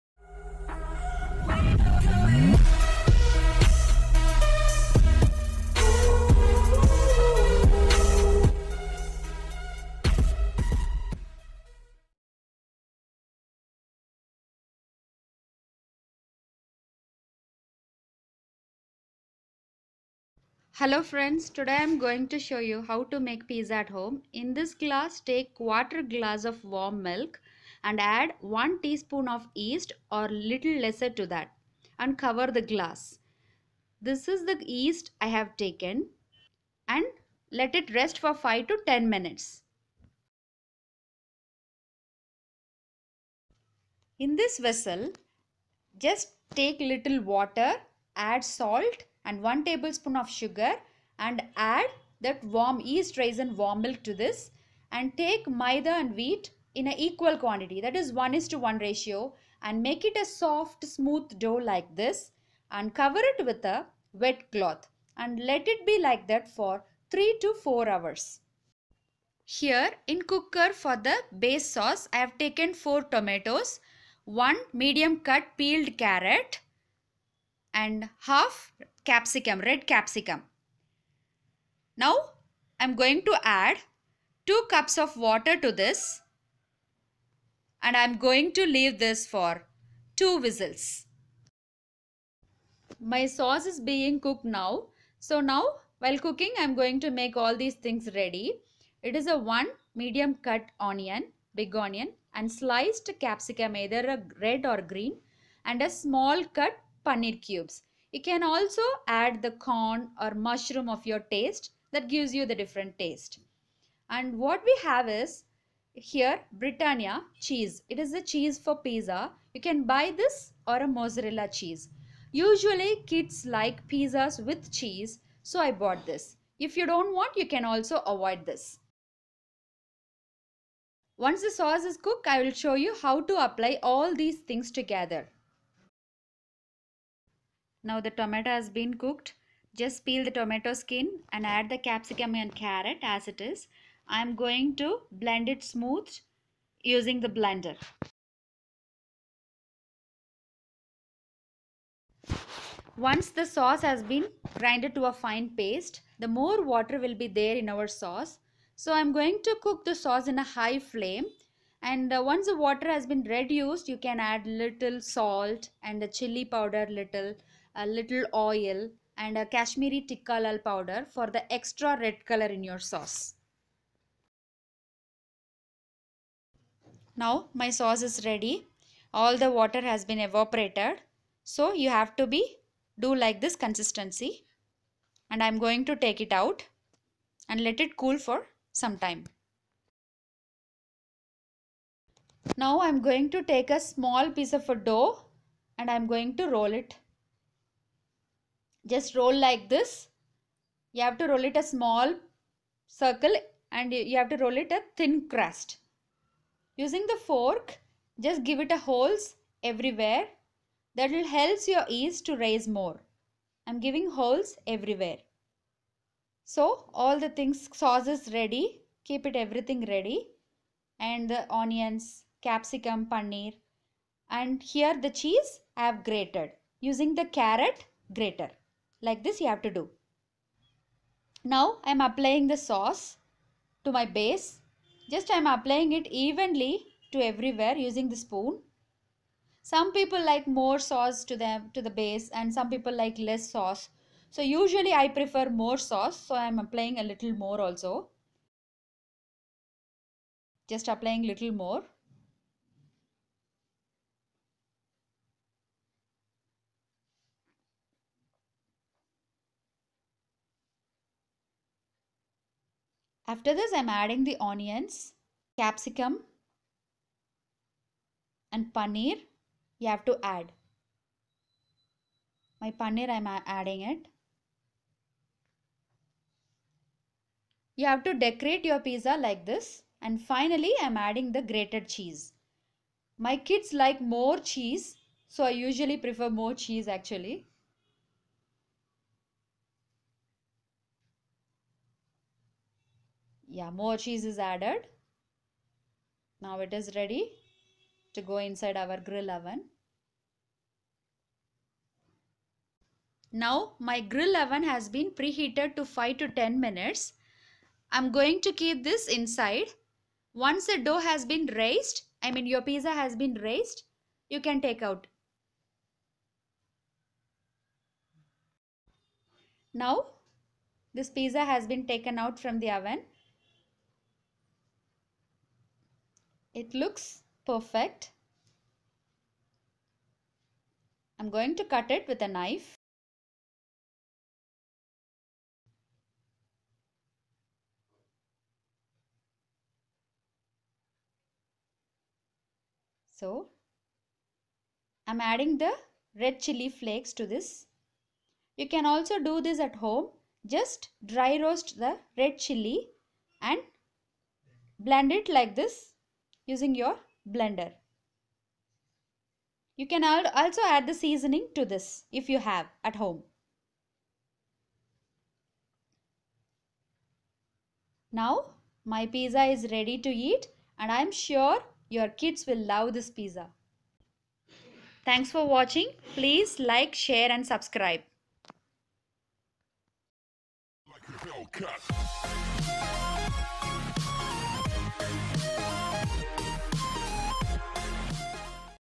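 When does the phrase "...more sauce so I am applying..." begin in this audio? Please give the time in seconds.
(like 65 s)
245 s.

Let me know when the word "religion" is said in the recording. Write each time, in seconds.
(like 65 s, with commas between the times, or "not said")
not said.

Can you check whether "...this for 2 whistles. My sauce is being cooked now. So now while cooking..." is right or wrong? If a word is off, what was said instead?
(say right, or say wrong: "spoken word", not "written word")
right.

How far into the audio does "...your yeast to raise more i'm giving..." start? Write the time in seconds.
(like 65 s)
211 s.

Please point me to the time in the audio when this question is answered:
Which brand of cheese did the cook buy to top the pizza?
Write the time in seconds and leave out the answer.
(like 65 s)
116 s.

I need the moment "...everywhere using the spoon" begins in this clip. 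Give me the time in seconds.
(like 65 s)
237 s.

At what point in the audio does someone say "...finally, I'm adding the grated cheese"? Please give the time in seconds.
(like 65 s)
280 s.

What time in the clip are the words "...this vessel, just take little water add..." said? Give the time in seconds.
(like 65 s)
44 s.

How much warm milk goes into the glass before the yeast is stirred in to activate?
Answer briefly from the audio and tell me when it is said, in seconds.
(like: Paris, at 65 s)
Quarter glass, at 25 s.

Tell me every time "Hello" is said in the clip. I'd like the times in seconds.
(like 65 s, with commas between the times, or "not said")
20 s.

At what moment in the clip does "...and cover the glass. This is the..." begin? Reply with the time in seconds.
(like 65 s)
31 s.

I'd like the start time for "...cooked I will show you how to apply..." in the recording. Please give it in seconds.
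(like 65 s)
131 s.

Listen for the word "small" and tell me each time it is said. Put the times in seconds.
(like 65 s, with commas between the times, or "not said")
105 s, 193 s, 201 s.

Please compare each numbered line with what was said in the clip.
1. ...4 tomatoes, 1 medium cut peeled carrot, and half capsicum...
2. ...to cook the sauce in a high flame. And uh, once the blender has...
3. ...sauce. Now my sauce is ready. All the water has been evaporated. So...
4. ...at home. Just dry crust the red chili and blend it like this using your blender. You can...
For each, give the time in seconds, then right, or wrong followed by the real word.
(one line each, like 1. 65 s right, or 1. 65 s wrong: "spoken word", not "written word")
1. 72 s right
2. 159 s wrong: "water", not "blender"
3. 172 s right
4. 349 s wrong: "roast", not "crust".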